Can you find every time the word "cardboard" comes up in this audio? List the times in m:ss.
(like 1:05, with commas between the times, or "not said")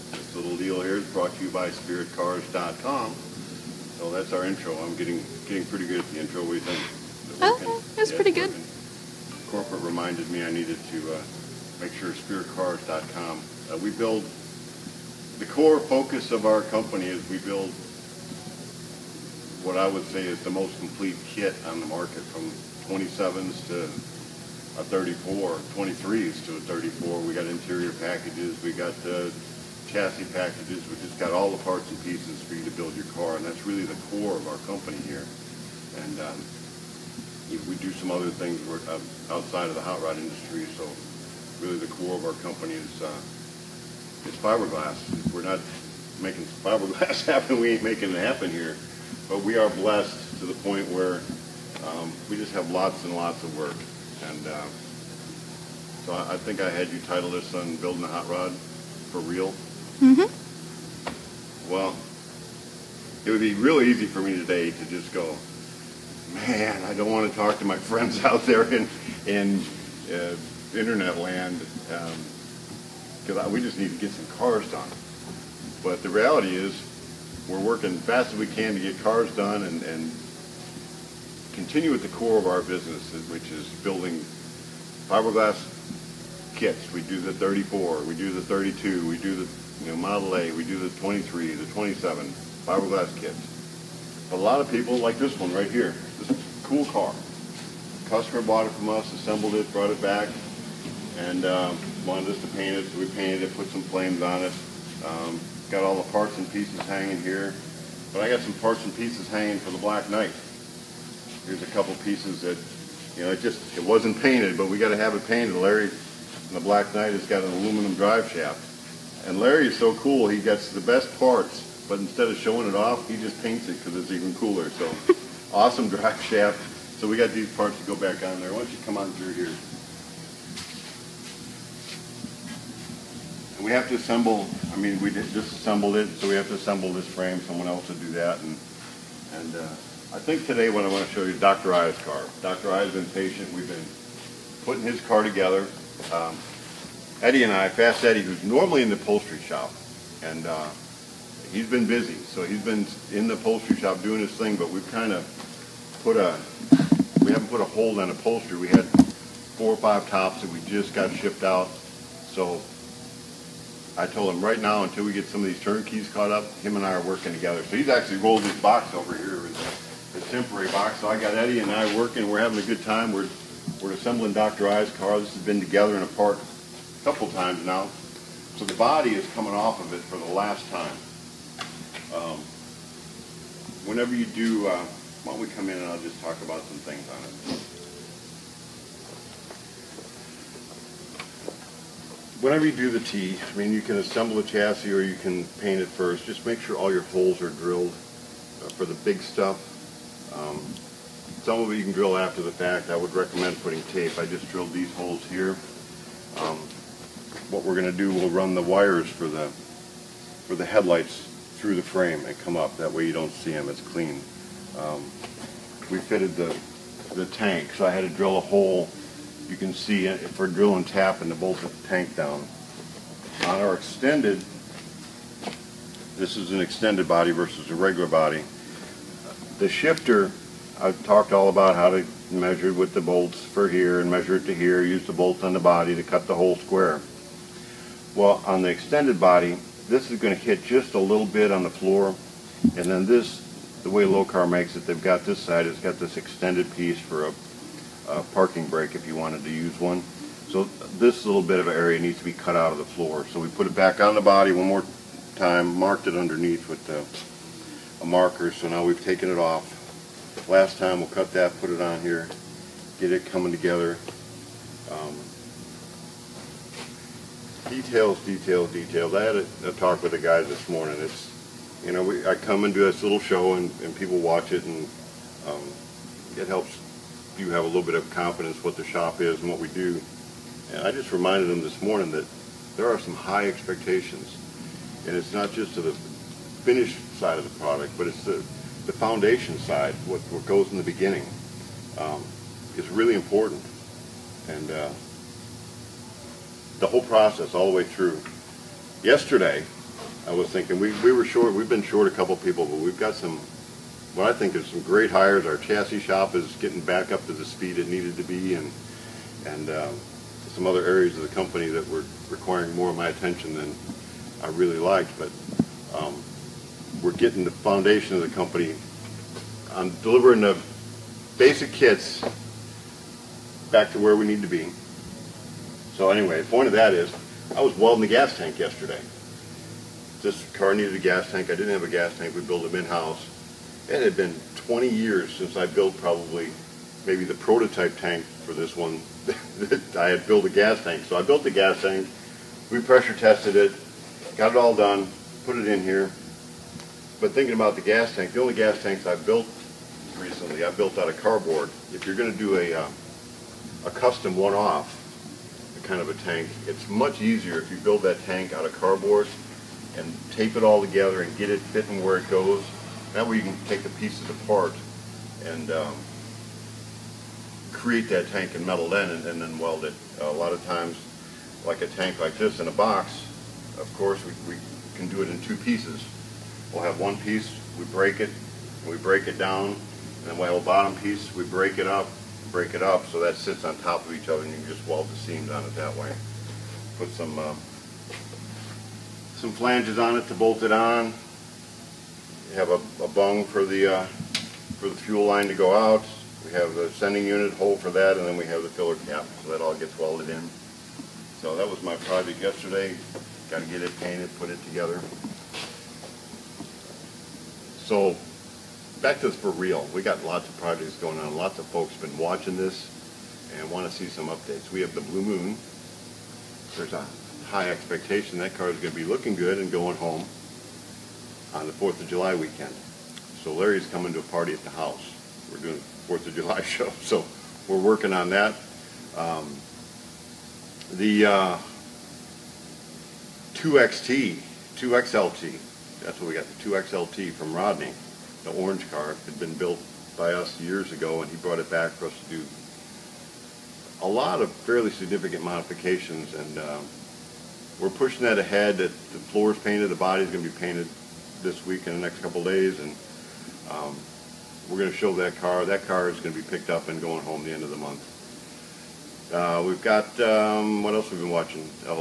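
5:51, 5:58.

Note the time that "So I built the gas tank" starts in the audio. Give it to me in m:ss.
5:41.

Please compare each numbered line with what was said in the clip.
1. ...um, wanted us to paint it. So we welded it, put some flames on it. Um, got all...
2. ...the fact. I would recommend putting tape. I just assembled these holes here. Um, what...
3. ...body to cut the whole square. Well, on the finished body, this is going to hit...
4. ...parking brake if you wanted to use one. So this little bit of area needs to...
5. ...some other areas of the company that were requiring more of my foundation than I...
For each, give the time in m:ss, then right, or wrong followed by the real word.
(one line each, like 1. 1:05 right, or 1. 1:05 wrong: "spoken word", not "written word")
1. 1:41 wrong: "painted", not "welded"
2. 3:22 wrong: "drilled", not "assembled"
3. 3:55 wrong: "extended", not "finished"
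4. 4:08 right
5. 5:10 wrong: "attention", not "foundation".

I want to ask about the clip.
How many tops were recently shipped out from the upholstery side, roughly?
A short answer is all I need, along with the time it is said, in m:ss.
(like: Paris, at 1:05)
four or five, at 2:38.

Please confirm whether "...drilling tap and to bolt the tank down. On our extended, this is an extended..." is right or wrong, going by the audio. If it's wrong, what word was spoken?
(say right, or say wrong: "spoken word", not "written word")
right.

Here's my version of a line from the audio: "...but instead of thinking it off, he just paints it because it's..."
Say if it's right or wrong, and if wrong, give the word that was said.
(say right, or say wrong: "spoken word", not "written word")
wrong: "showing", not "thinking".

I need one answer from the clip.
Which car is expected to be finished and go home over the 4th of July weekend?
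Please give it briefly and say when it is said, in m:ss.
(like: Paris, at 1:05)
Blue Moon, at 6:55.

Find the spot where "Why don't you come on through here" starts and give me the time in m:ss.
2:08.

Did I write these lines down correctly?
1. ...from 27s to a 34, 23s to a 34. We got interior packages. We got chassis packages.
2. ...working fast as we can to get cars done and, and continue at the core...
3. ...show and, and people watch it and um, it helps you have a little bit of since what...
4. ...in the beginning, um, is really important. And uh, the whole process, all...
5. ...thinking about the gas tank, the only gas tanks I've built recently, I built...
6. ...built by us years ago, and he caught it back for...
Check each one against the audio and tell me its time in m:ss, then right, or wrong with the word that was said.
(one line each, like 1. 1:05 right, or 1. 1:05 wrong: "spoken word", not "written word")
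1. 0:22 right
2. 1:17 right
3. 4:33 wrong: "confidence", not "since"
4. 4:50 right
5. 5:47 right
6. 7:19 wrong: "brought", not "caught".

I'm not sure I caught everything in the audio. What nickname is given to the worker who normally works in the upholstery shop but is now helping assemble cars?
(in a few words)
Fast Eddie.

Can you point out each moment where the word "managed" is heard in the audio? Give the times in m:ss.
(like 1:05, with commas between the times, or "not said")
not said.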